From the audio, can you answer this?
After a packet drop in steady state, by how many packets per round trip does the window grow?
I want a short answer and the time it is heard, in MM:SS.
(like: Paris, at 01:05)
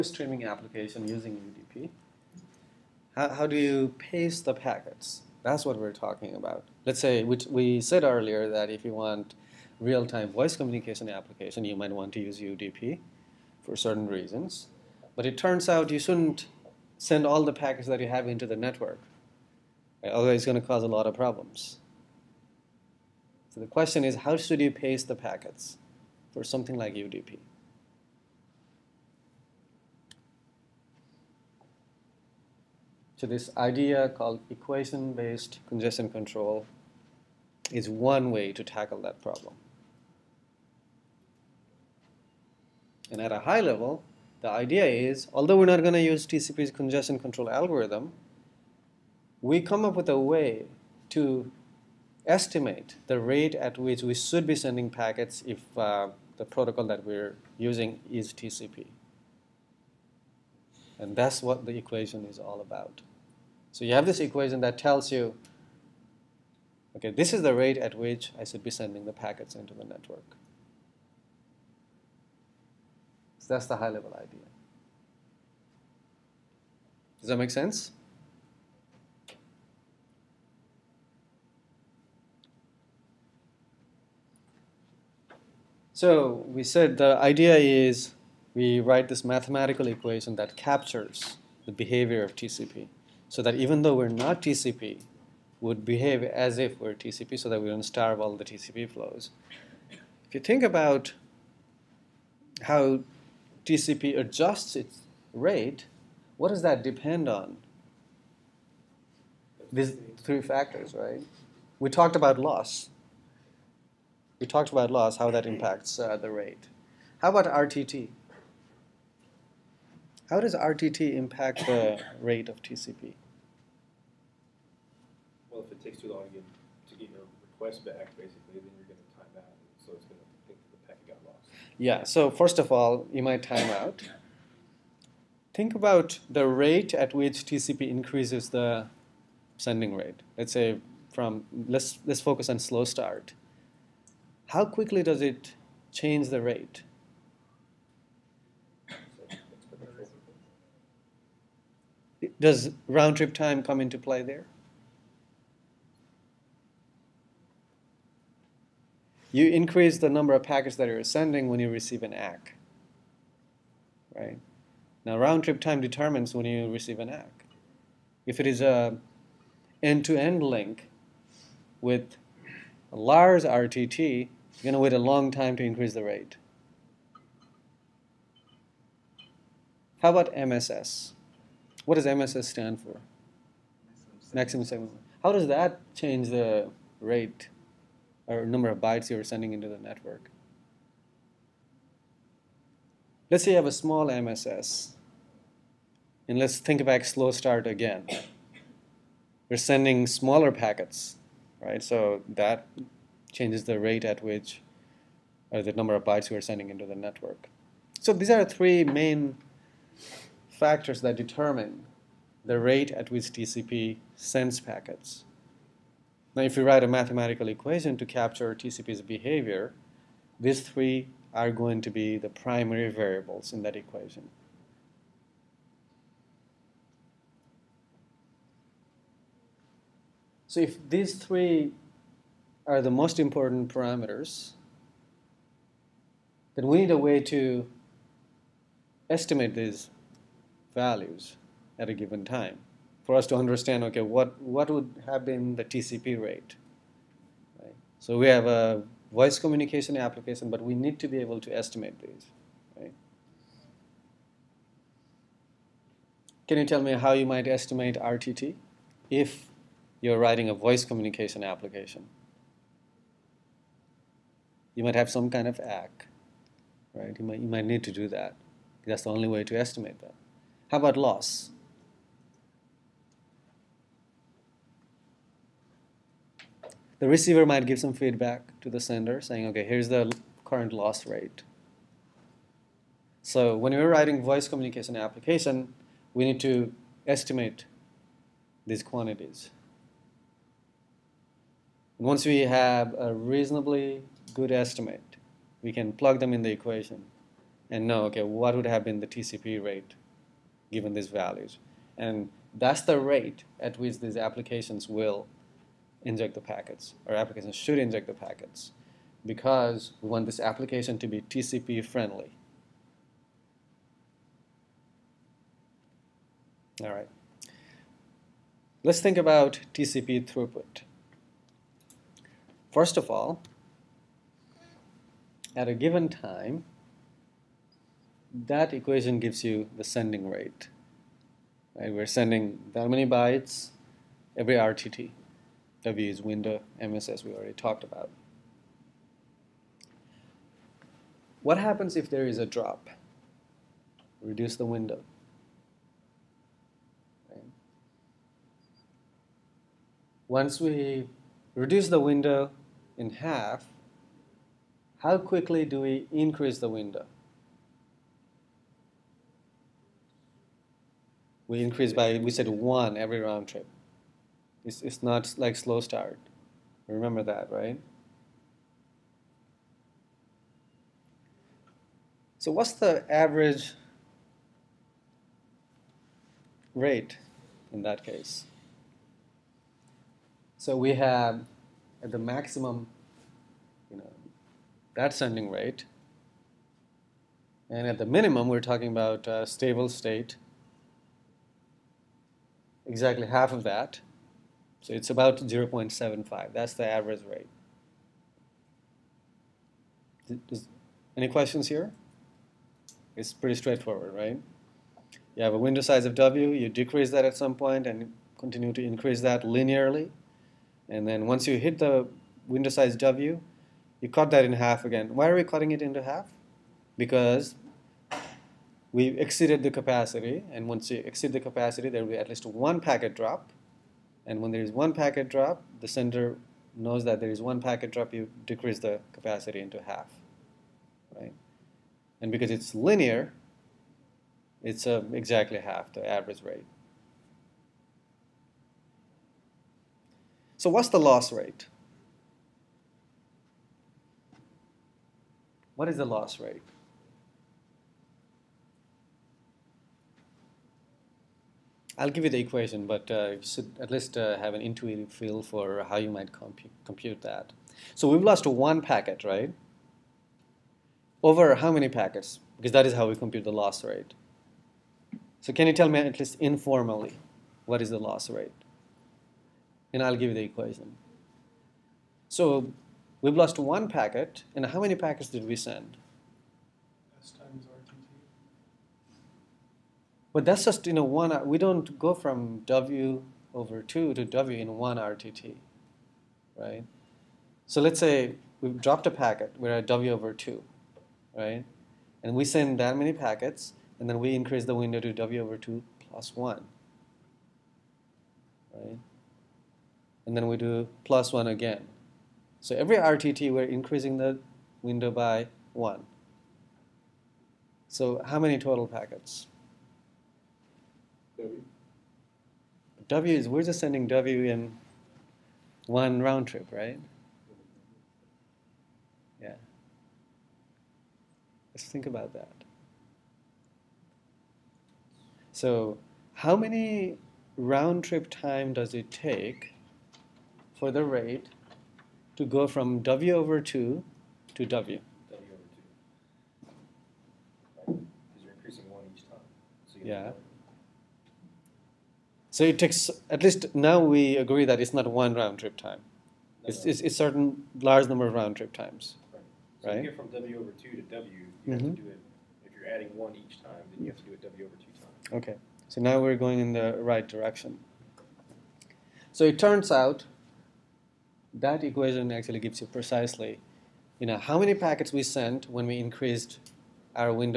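1, at 06:02.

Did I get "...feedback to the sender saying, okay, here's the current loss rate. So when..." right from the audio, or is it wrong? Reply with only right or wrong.
right.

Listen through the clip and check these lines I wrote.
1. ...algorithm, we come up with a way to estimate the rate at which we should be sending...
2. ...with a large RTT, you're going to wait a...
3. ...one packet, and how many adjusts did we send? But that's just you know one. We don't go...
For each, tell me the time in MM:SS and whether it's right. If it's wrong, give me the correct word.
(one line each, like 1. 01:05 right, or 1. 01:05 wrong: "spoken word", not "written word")
1. 00:47 right
2. 02:51 right
3. 07:53 wrong: "packets", not "adjusts".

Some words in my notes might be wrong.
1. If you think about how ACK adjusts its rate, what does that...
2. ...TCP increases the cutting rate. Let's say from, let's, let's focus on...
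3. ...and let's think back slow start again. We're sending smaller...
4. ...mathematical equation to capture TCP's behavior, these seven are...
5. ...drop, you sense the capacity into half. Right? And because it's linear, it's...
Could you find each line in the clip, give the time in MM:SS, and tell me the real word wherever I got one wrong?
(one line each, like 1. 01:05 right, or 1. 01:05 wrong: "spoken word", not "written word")
1. 01:40 wrong: "TCP", not "ACK"
2. 02:17 wrong: "sending", not "cutting"
3. 03:16 right
4. 03:36 wrong: "three", not "seven"
5. 07:07 wrong: "decrease", not "sense".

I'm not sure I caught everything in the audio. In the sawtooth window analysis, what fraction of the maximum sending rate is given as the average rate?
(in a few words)
0.75.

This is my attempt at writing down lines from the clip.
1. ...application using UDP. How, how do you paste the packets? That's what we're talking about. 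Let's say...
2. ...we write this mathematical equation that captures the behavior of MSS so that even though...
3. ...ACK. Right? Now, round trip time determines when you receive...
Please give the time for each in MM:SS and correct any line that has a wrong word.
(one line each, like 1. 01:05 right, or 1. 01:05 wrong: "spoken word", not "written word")
1. 00:00 right
2. 01:28 wrong: "TCP", not "MSS"
3. 02:42 right.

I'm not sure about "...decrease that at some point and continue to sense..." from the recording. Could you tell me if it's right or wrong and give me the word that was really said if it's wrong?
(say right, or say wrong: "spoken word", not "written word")
wrong: "increase", not "sense".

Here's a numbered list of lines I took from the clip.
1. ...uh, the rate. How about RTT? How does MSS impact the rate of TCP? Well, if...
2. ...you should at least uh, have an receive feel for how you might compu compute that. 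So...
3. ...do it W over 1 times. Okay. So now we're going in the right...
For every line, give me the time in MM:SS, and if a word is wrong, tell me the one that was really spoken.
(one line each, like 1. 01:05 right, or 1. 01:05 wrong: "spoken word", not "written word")
1. 01:55 wrong: "RTT", not "MSS"
2. 07:33 wrong: "intuitive", not "receive"
3. 09:14 wrong: "2", not "1".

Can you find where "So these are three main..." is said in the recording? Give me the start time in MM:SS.
03:27.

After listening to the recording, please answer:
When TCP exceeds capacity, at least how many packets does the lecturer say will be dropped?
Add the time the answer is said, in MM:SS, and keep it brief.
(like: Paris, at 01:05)
1, at 07:02.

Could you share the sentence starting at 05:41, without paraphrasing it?
What happens if there is a drop?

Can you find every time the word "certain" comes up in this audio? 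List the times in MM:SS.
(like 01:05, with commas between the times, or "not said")
00:13, 09:07.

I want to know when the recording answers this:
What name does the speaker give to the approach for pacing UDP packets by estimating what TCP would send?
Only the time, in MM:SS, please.
00:34.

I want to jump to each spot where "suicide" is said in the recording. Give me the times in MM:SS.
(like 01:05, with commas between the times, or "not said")
not said.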